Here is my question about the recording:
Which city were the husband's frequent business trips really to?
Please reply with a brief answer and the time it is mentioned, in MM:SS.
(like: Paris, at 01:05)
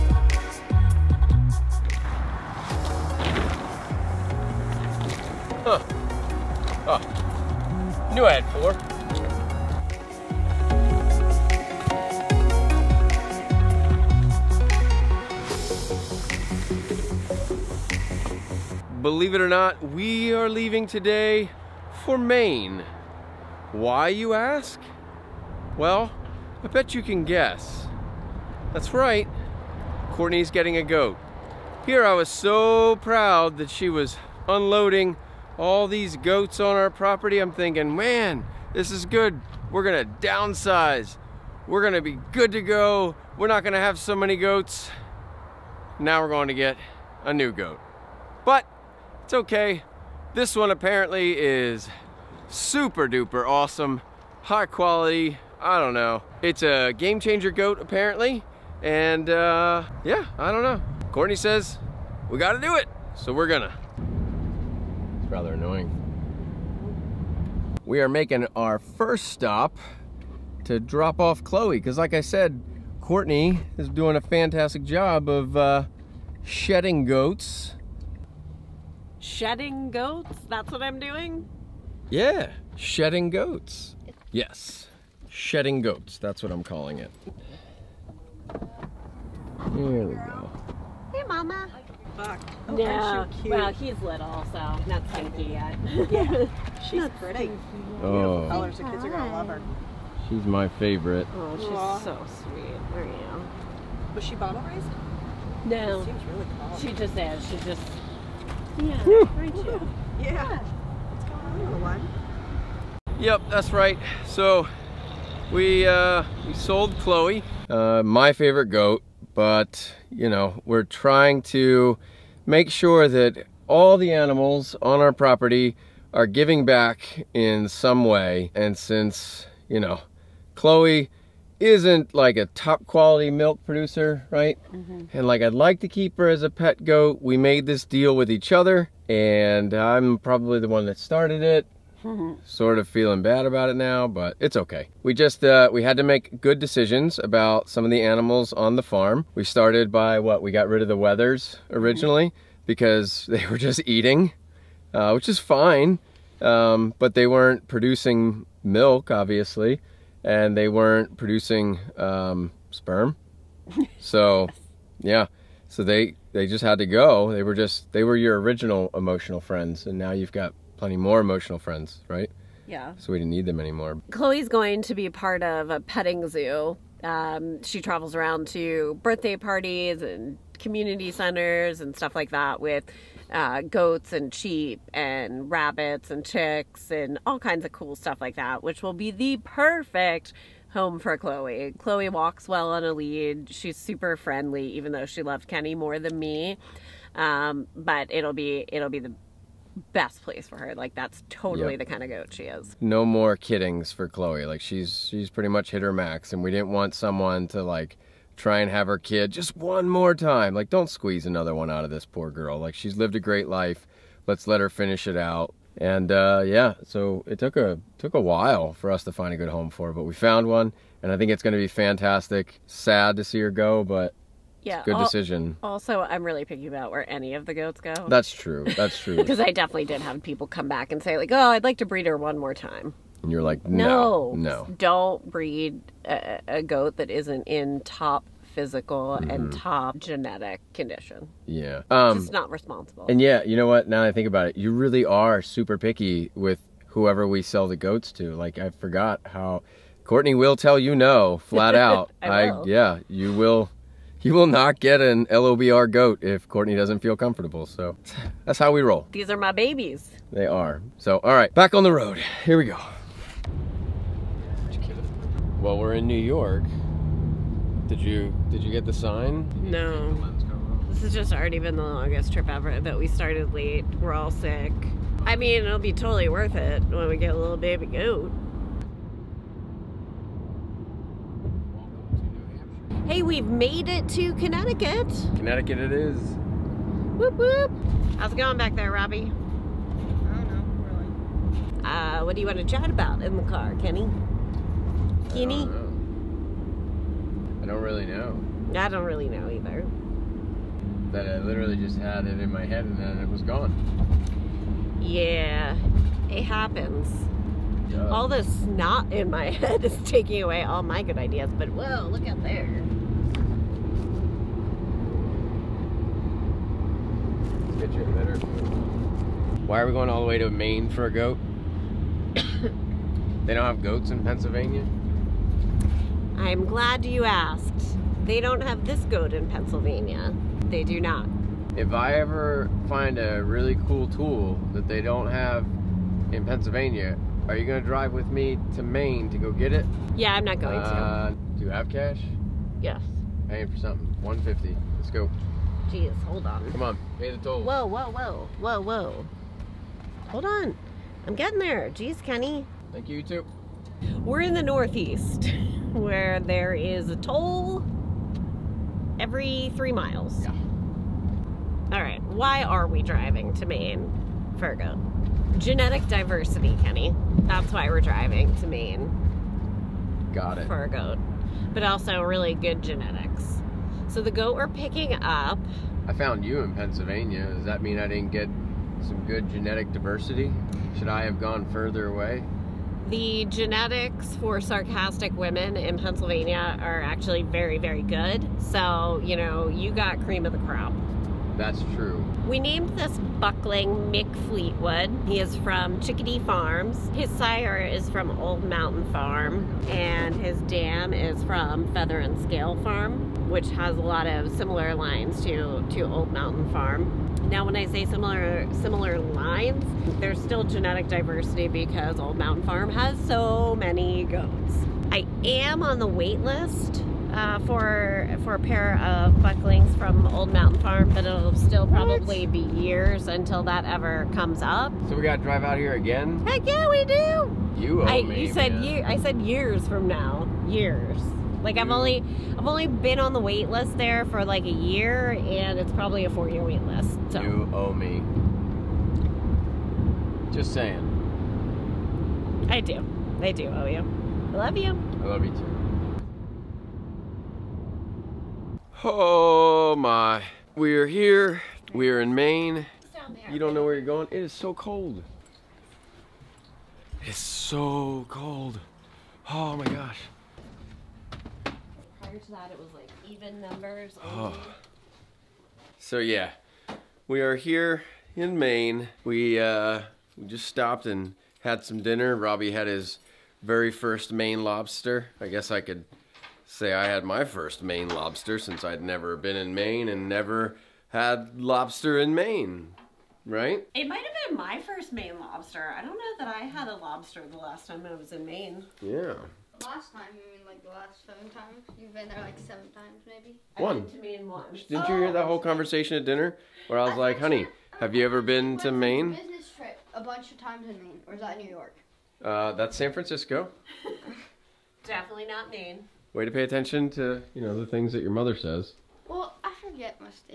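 San Francisco, at 08:22.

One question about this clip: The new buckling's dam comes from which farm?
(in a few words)
Feather and Scale Farm.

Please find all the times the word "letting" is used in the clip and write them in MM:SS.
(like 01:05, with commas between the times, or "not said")
not said.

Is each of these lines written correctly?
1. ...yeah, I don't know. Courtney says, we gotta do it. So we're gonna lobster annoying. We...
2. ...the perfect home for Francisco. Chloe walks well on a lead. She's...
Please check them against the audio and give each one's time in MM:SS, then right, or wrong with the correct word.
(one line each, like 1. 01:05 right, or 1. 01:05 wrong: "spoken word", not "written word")
1. 01:00 wrong: "rather", not "lobster"
2. 03:09 wrong: "Chloe", not "Francisco".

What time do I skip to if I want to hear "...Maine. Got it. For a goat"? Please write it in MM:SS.
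06:08.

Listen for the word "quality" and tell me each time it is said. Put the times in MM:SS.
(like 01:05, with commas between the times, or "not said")
00:54, 02:12.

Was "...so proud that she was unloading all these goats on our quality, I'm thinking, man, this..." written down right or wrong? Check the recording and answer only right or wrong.
wrong.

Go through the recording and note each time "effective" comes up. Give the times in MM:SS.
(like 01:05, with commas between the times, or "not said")
not said.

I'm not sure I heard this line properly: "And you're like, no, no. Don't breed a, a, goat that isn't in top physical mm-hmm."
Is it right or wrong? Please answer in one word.
right.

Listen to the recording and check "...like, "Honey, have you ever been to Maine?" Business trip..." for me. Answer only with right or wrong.
right.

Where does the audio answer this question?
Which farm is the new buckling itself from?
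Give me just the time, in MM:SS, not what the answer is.
06:35.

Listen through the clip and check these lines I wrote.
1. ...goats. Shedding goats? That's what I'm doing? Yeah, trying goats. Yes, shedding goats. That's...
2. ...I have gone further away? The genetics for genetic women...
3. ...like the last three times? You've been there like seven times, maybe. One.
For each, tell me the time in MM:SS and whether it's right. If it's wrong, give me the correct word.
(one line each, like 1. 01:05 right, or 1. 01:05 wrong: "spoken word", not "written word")
1. 01:17 wrong: "shedding", not "trying"
2. 06:21 wrong: "sarcastic", not "genetic"
3. 08:10 wrong: "seven", not "three".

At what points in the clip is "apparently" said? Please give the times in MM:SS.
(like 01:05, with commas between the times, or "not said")
00:50, 00:57.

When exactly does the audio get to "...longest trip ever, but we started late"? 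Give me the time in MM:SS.
04:31.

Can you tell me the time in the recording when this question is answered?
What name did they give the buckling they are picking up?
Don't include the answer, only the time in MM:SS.
06:34.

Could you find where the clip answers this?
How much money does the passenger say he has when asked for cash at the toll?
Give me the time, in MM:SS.
05:44.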